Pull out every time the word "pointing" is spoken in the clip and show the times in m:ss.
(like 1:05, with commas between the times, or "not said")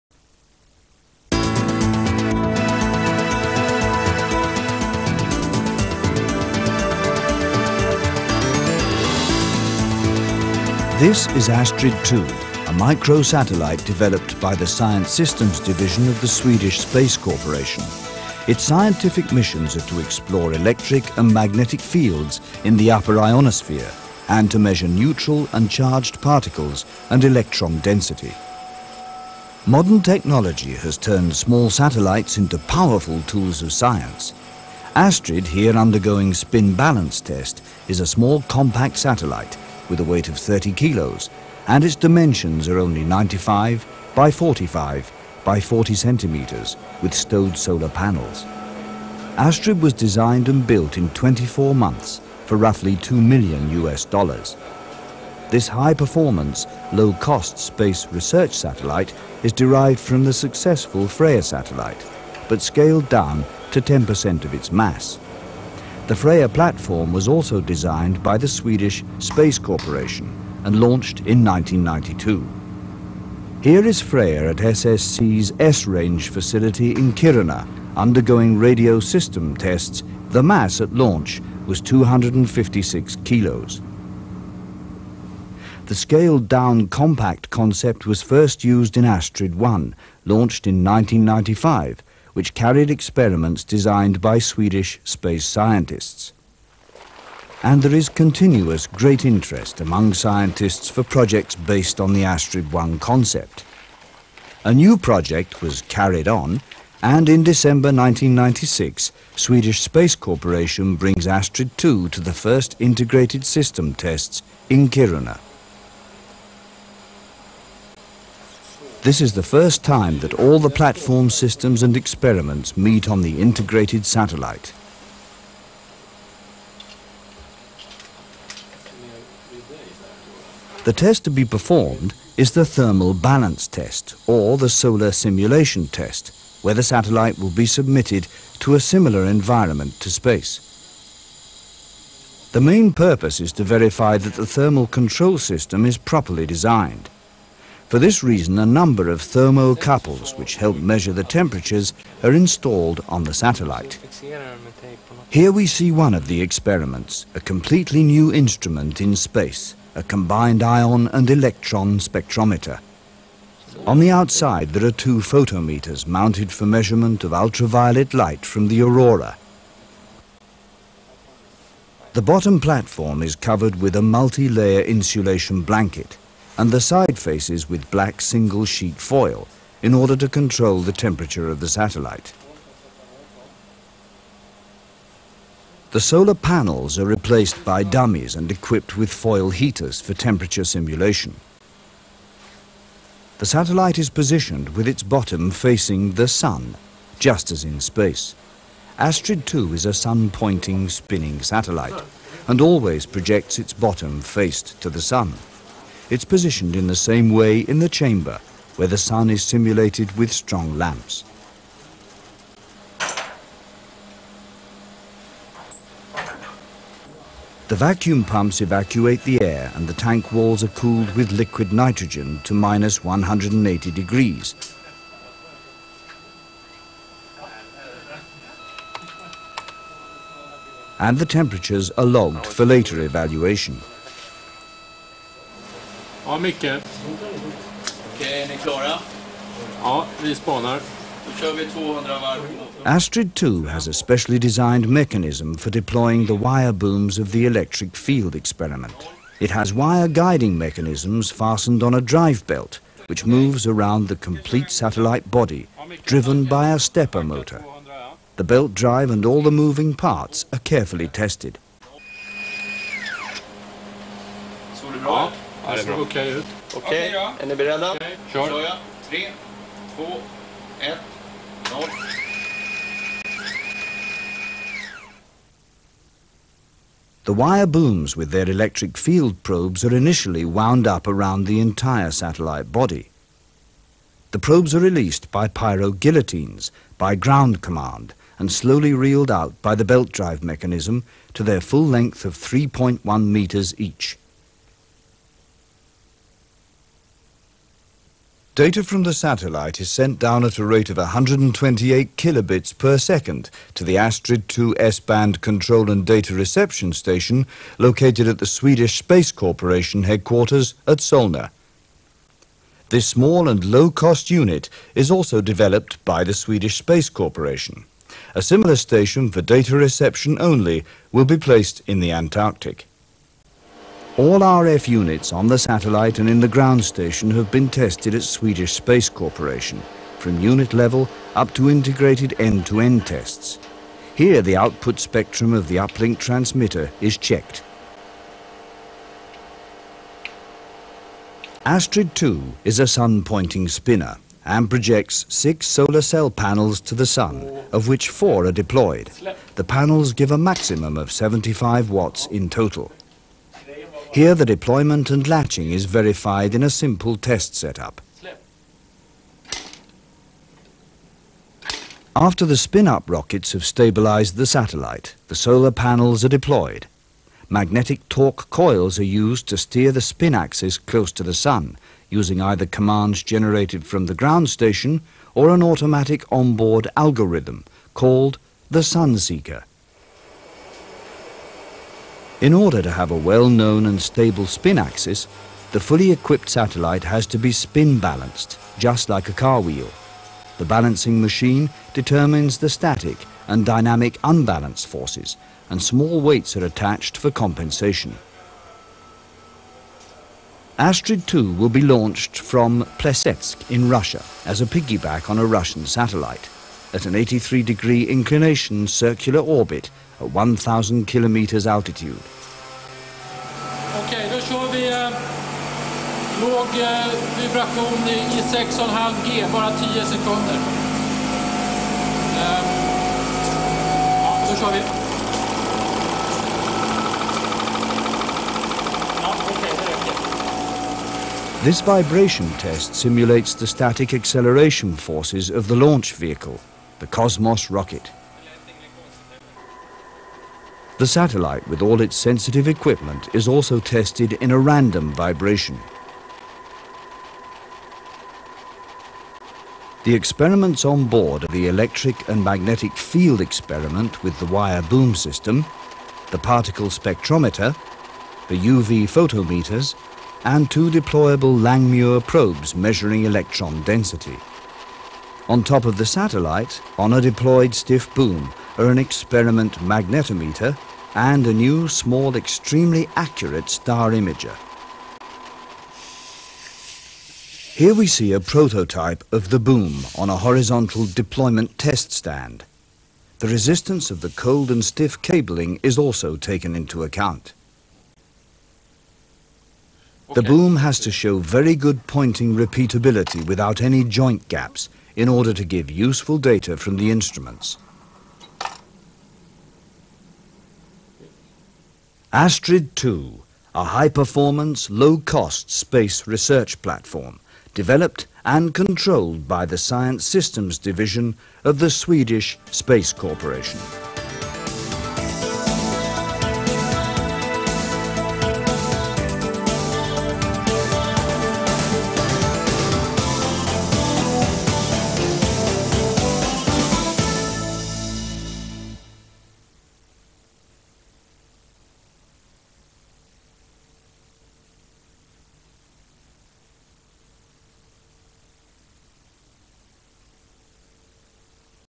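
3:19, 5:42, 8:12.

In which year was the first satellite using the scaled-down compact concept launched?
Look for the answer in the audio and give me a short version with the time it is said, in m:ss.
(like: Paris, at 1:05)
1995, at 1:30.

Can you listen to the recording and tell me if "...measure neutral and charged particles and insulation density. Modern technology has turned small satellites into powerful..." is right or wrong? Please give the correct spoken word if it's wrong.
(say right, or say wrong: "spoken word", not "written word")
wrong: "electron", not "insulation".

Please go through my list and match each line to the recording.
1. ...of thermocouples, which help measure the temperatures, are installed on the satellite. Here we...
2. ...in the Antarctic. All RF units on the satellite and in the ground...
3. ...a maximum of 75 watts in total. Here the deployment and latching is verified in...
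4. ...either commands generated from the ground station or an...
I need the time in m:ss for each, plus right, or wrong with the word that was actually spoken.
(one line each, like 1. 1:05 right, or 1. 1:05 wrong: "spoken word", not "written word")
1. 2:29 right
2. 5:21 right
3. 5:50 right
4. 6:12 right.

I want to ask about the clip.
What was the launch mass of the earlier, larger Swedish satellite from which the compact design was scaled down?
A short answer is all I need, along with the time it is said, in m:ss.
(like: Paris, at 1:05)
256 kilos, at 1:21.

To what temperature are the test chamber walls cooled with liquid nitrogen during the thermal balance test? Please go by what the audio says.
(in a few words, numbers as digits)
-180 degrees.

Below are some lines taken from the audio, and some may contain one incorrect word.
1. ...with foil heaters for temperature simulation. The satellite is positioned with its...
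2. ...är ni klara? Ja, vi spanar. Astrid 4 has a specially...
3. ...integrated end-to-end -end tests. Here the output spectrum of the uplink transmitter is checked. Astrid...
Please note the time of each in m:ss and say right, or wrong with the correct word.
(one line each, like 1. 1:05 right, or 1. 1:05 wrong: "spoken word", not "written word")
1. 3:08 right
2. 3:58 wrong: "2", not "4"
3. 5:31 right.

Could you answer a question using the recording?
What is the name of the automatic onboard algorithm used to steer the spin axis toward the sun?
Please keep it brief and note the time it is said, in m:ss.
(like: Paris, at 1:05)
Sunseeker, at 6:18.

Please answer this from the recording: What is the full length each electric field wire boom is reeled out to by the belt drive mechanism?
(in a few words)
3.1 meters.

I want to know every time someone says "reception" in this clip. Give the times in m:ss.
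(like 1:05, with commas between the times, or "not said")
5:06, 5:19.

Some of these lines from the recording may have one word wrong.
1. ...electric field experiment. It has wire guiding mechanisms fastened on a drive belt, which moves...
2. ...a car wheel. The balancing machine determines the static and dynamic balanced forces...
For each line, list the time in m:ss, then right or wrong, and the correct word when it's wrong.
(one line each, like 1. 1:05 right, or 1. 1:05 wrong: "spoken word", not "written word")
1. 4:07 right
2. 6:29 wrong: "unbalanced", not "balanced".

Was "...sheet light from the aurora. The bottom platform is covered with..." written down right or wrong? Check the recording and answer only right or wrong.
wrong.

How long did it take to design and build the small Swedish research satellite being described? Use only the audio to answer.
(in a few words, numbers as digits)
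24 months.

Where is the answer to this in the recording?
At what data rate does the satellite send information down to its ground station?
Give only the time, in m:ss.
5:00.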